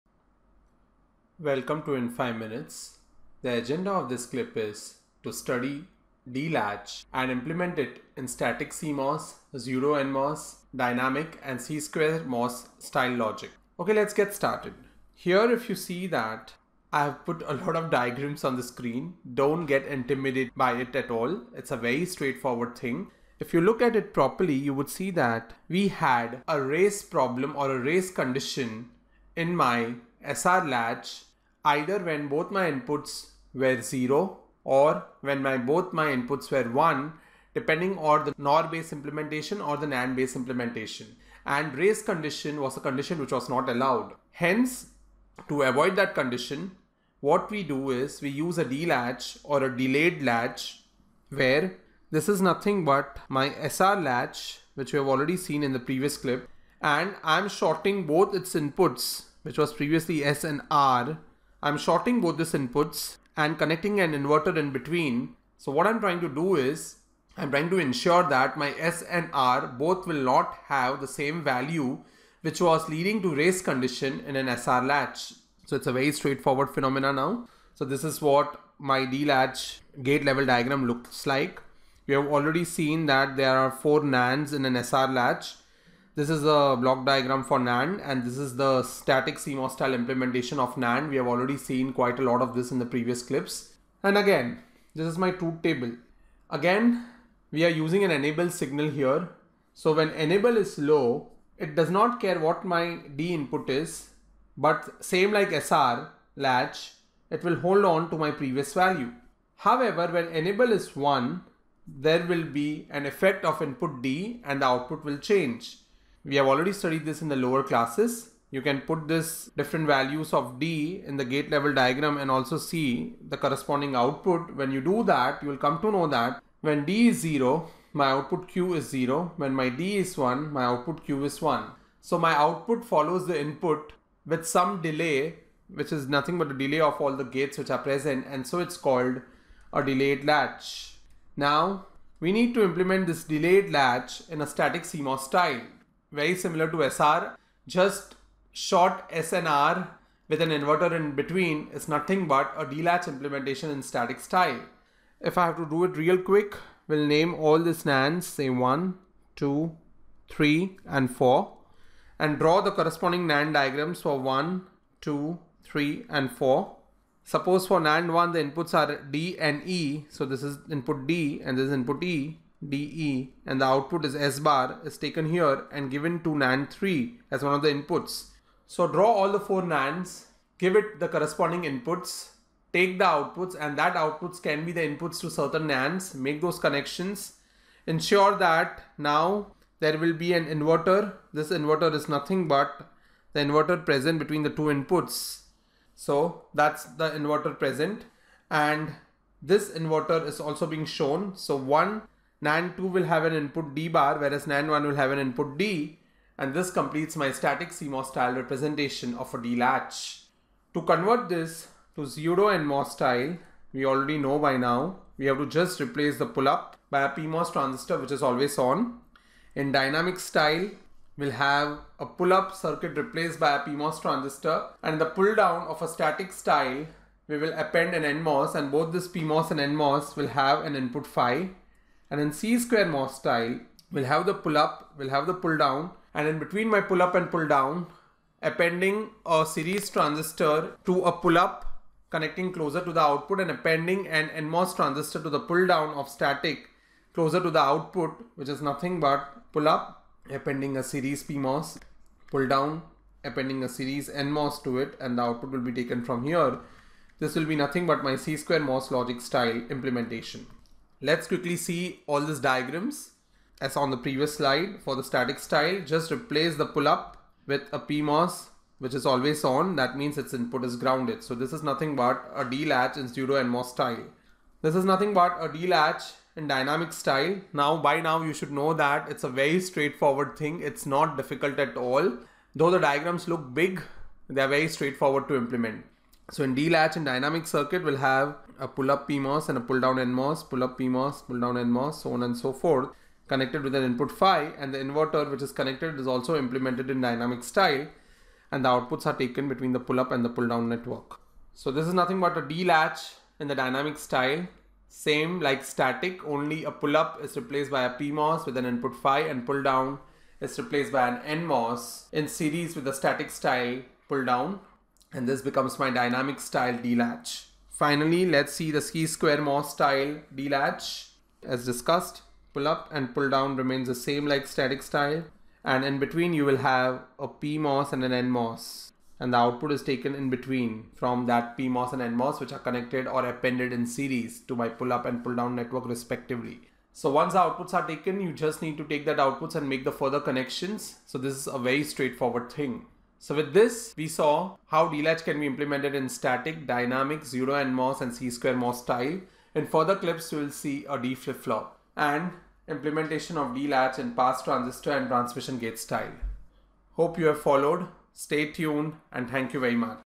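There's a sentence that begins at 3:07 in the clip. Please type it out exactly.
Ensure that now there will be an inverter.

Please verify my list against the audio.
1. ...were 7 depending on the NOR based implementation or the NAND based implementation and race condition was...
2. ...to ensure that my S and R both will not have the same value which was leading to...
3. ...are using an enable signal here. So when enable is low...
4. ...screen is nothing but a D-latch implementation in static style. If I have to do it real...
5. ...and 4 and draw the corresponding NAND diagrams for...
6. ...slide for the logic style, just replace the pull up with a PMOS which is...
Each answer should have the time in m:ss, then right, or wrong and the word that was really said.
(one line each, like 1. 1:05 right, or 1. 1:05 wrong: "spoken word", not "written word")
1. 0:36 wrong: "1", not "7"
2. 1:07 right
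3. 1:37 right
4. 2:31 wrong: "between", not "screen"
5. 2:40 right
6. 4:24 wrong: "static", not "logic".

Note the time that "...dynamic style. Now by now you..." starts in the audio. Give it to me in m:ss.
4:36.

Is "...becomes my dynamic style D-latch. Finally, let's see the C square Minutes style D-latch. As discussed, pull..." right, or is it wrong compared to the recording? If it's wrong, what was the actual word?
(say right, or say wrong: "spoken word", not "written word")
wrong: "MOS", not "Minutes".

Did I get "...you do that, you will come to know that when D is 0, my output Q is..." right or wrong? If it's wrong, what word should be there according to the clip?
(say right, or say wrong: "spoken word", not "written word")
right.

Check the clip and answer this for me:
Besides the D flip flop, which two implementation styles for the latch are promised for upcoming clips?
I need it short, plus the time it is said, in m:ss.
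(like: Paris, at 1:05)
Pass transistor and transmission gate, at 5:54.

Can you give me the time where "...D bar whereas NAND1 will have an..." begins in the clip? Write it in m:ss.
3:23.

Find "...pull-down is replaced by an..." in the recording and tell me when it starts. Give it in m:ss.
5:09.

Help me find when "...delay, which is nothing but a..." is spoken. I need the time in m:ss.
2:14.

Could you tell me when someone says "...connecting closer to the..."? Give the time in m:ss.
4:02.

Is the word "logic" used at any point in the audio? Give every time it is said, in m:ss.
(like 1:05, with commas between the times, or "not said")
0:13, 4:18.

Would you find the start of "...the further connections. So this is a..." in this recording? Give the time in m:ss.
5:39.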